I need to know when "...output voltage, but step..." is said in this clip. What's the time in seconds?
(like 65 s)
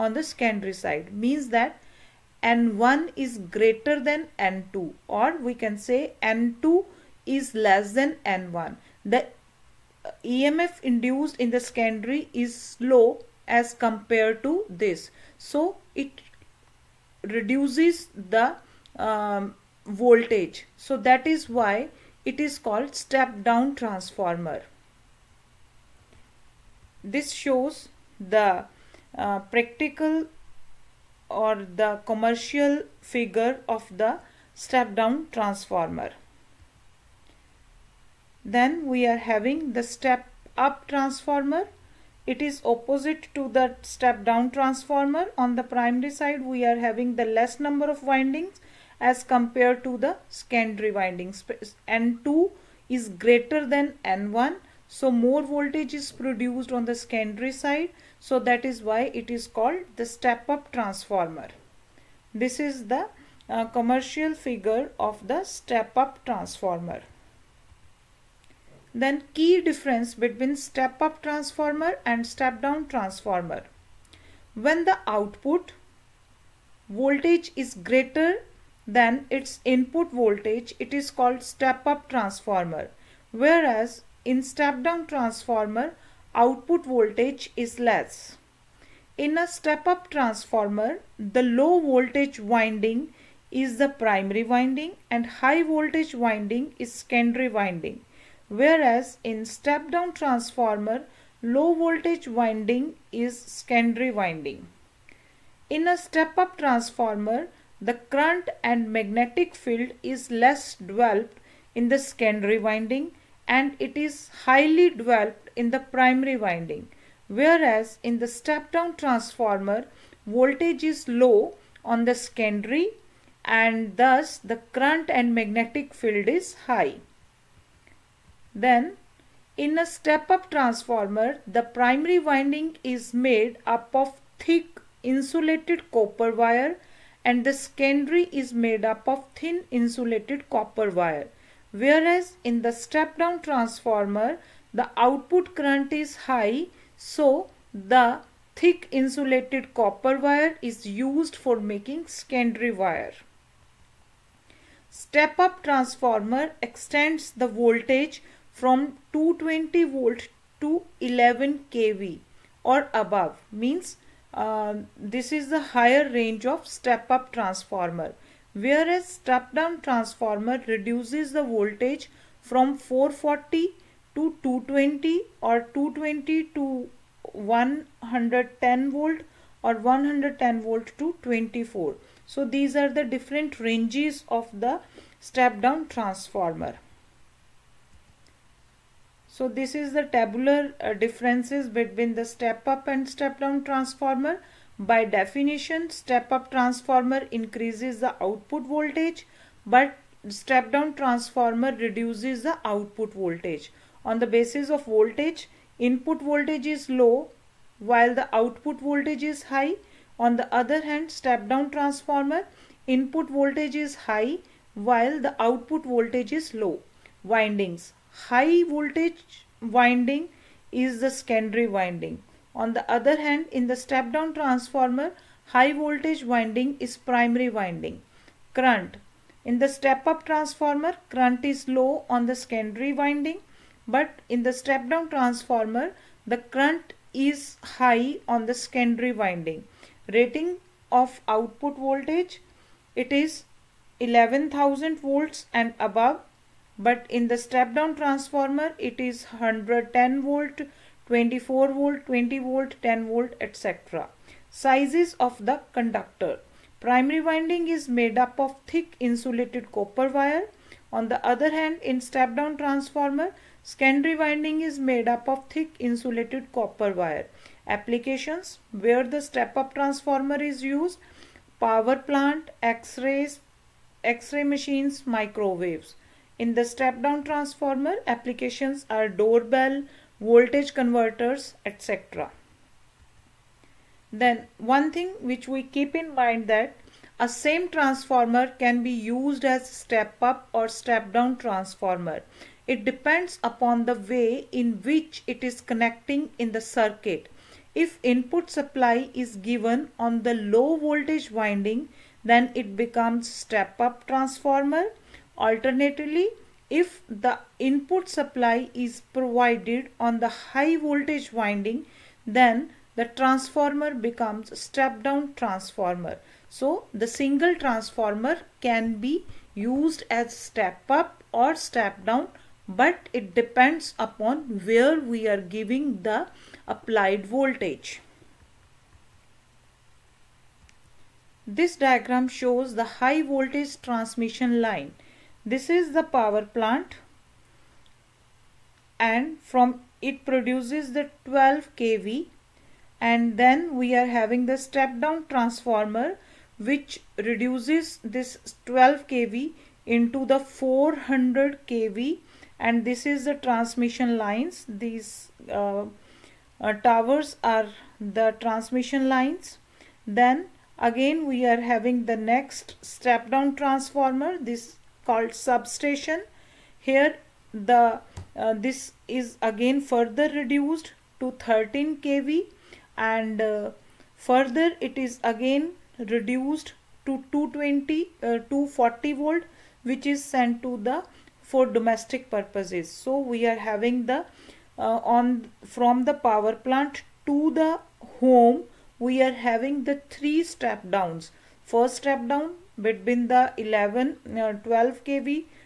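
198 s.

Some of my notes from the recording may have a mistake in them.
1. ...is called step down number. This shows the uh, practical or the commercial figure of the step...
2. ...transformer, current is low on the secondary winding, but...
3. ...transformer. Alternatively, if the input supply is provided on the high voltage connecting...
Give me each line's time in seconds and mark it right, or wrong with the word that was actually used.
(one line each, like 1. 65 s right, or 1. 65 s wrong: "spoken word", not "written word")
1. 22 s wrong: "transformer", not "number"
2. 230 s right
3. 304 s wrong: "winding", not "connecting".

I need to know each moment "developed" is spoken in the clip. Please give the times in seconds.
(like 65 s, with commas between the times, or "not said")
110 s, 114 s.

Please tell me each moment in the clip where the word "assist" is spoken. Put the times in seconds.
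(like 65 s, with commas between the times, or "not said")
not said.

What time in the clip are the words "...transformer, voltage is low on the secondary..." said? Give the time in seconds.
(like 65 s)
118 s.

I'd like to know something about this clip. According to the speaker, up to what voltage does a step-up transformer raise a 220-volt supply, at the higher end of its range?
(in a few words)
11 kV.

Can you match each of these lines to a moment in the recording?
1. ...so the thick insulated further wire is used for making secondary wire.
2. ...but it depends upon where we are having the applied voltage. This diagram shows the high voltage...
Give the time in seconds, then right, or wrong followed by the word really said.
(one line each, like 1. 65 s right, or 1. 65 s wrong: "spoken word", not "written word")
1. 146 s wrong: "copper", not "further"
2. 322 s wrong: "giving", not "having".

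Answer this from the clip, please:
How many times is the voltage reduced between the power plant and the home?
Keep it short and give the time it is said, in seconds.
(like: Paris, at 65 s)
three, at 390 s.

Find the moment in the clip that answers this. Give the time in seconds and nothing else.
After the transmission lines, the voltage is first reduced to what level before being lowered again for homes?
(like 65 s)
371 s.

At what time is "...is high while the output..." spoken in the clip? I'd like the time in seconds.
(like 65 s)
213 s.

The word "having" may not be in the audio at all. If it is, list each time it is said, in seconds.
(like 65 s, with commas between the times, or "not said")
39 s, 46 s, 344 s, 361 s, 383 s, 389 s.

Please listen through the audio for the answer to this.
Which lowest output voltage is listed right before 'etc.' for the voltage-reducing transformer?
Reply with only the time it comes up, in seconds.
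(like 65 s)
252 s.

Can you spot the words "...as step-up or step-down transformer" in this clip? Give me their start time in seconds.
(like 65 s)
289 s.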